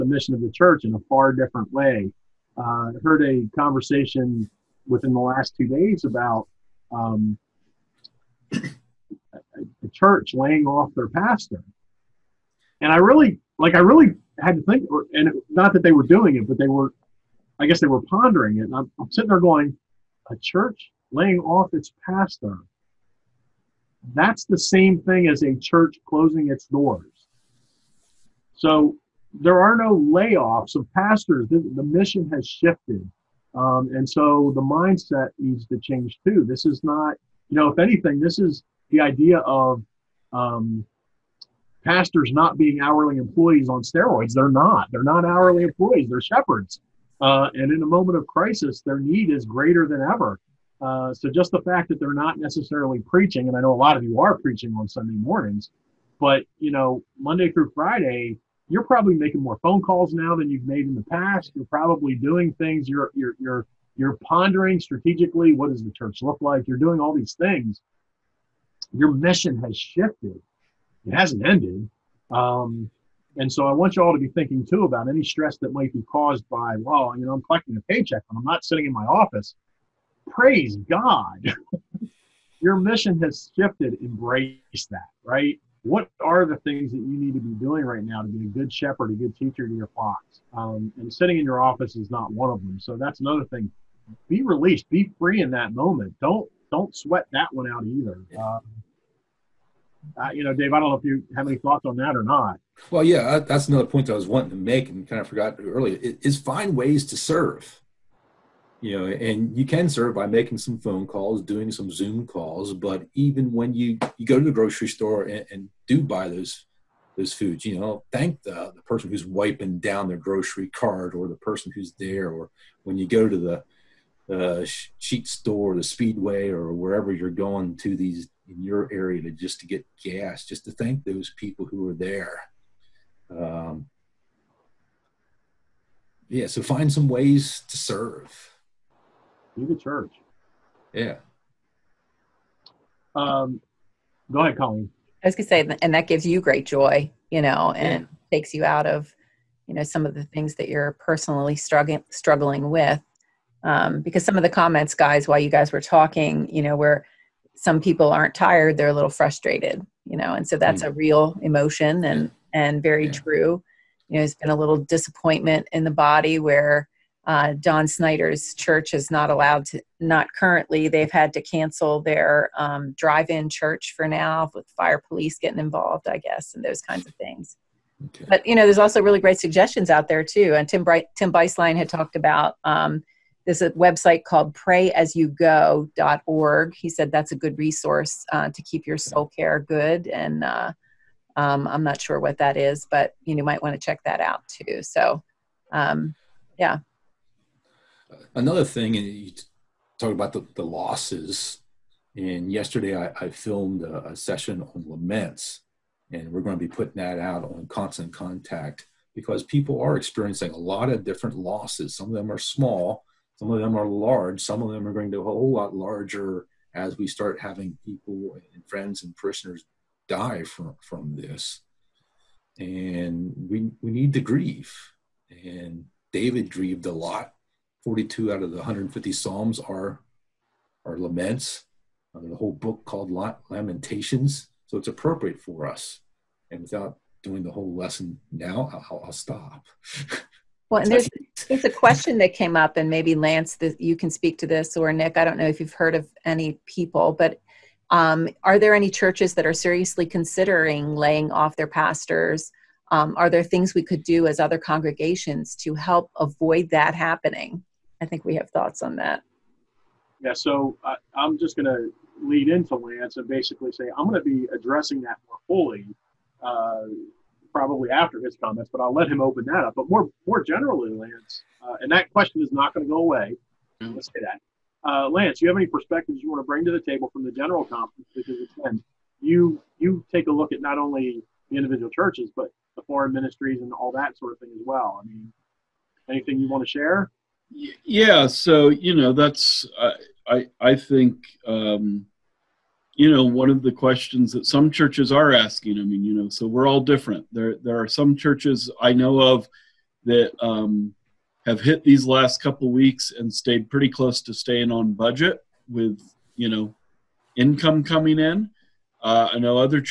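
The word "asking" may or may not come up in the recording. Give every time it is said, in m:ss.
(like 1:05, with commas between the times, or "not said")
4:55.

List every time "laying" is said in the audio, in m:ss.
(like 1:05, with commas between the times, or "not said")
0:10, 0:21, 4:10.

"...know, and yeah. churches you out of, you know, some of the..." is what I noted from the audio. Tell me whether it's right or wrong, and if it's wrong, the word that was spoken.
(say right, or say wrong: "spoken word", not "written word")
wrong: "takes", not "churches".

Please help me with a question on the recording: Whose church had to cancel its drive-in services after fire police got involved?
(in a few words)
Don Snyder.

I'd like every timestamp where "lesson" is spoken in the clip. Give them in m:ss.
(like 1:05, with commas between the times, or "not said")
3:57.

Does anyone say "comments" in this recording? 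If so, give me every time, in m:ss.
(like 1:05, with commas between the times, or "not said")
2:34, 4:28.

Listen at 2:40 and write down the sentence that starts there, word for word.
a real emotion and and very yeah.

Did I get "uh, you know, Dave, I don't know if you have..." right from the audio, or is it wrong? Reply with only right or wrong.
right.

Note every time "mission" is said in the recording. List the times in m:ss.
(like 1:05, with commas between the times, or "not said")
0:00, 0:31, 1:09, 1:22.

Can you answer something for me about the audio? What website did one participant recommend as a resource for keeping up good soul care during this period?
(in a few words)
prayasyougo.org.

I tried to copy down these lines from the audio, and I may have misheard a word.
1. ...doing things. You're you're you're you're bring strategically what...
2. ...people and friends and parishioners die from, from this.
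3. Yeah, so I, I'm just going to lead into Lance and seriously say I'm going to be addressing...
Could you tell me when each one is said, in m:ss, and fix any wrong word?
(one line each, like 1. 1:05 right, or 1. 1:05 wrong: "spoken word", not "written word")
1. 1:02 wrong: "pondering", not "bring"
2. 3:37 right
3. 4:20 wrong: "basically", not "seriously".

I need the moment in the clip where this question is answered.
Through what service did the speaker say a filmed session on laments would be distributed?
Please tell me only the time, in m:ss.
3:27.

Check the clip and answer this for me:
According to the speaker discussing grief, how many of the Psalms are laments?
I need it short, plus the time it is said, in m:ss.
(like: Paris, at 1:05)
42, at 3:47.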